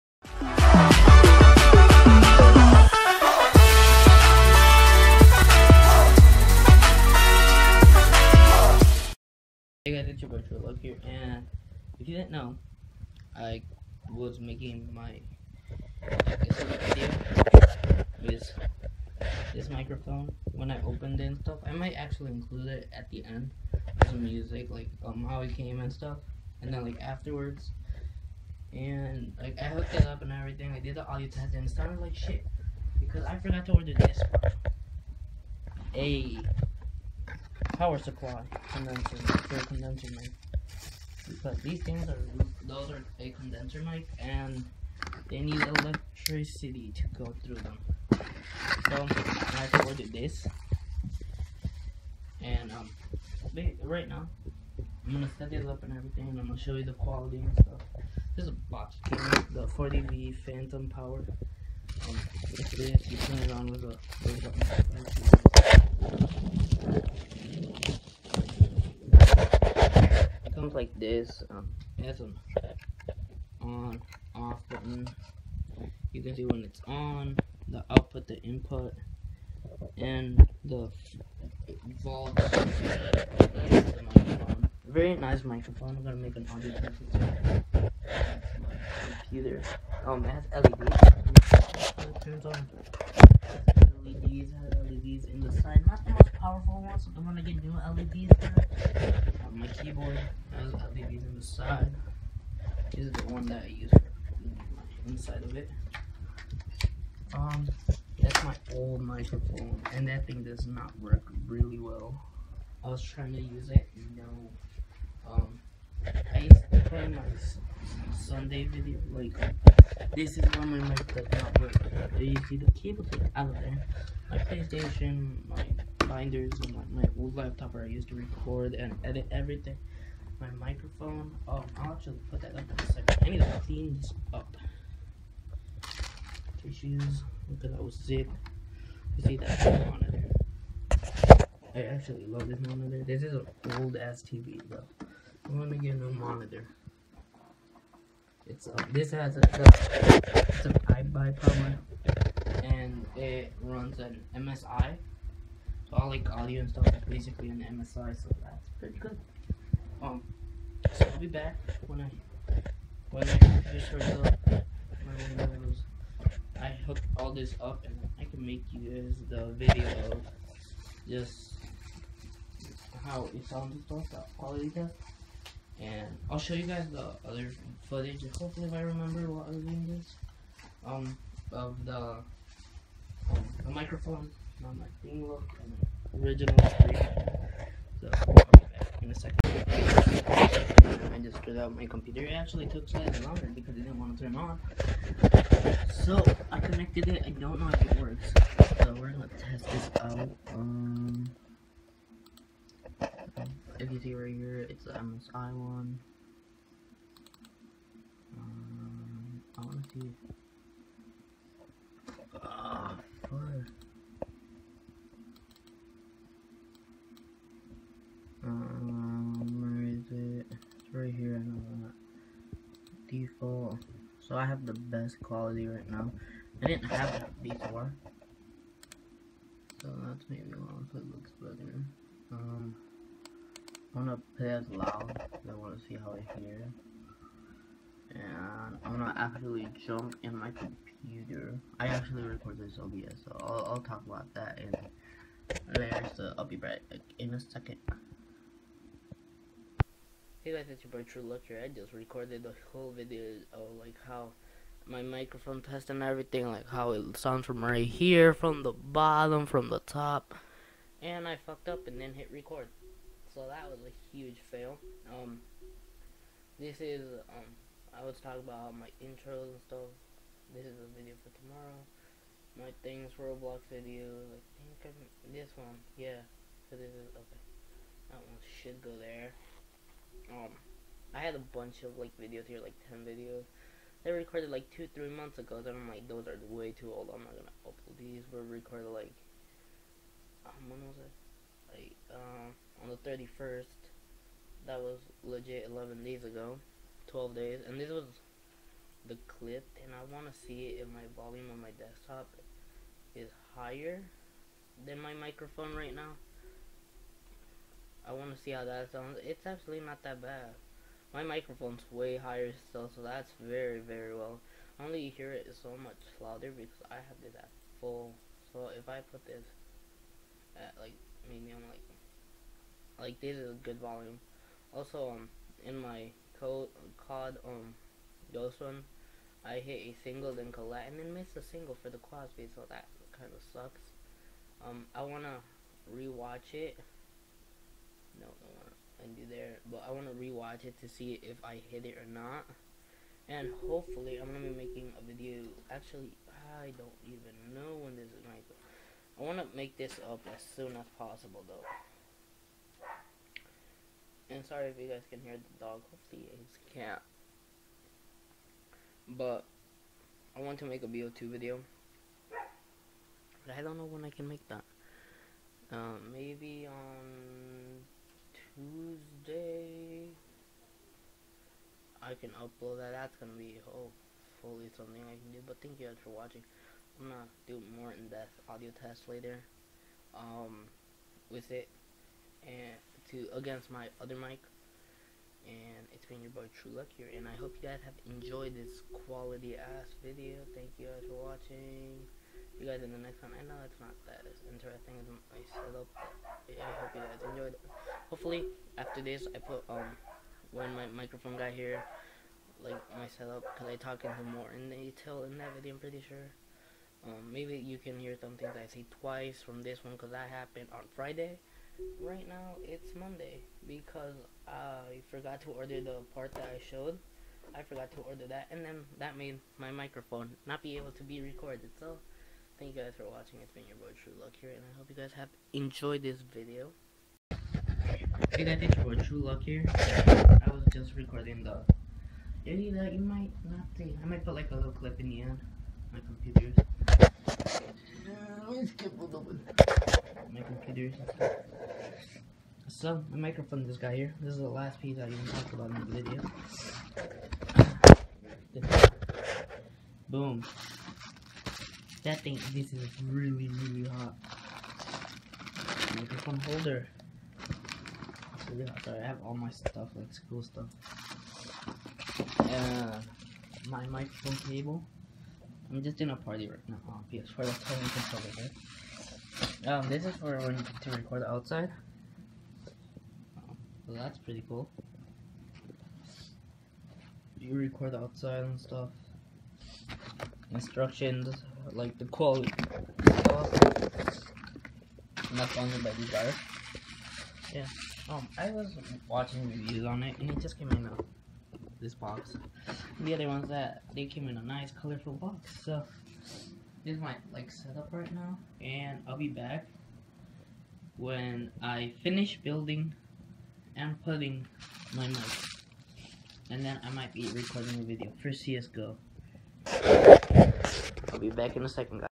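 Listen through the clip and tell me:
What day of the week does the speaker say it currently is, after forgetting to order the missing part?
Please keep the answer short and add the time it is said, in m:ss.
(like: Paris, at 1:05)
Monday, at 6:52.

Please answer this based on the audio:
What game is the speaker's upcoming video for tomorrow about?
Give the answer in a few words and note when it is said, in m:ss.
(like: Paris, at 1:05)
Roblox, at 4:33.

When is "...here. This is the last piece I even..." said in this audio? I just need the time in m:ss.
7:23.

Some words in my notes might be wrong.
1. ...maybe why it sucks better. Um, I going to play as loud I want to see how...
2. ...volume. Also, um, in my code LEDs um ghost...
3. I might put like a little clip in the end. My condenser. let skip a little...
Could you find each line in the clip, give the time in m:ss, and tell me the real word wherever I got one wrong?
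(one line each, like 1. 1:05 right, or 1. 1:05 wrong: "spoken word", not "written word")
1. 3:50 wrong: "looks", not "sucks"
2. 5:23 wrong: "COD", not "LEDs"
3. 7:14 wrong: "computer", not "condenser".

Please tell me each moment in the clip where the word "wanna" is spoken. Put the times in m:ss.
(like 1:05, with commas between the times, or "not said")
3:29, 5:35.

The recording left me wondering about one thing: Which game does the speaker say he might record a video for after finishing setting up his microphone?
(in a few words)
CSGO.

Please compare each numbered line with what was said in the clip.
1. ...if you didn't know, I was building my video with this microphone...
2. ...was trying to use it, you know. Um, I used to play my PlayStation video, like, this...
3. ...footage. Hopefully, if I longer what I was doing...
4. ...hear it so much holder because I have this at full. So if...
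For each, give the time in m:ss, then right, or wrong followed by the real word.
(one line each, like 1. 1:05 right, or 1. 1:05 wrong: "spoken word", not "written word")
1. 0:11 wrong: "making", not "building"
2. 1:52 wrong: "Sunday", not "PlayStation"
3. 2:57 wrong: "remember", not "longer"
4. 5:15 wrong: "louder", not "holder".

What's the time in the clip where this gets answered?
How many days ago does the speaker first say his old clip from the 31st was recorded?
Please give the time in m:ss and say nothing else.
4:55.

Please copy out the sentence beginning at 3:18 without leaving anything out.
So we're gonna test this out.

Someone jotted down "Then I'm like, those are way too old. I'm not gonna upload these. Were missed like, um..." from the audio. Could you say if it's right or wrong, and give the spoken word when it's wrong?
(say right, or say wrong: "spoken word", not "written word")
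wrong: "recorded", not "missed".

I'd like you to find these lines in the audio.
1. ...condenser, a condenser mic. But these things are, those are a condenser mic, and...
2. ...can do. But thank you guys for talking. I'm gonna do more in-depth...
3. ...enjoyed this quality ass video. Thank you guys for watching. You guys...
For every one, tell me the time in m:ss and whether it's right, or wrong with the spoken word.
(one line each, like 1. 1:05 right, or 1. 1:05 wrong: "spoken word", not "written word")
1. 0:38 right
2. 6:15 wrong: "watching", not "talking"
3. 6:28 right.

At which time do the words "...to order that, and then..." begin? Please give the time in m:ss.
6:57.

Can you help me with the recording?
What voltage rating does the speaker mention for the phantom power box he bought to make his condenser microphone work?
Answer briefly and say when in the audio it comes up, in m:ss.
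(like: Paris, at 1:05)
40V, at 0:59.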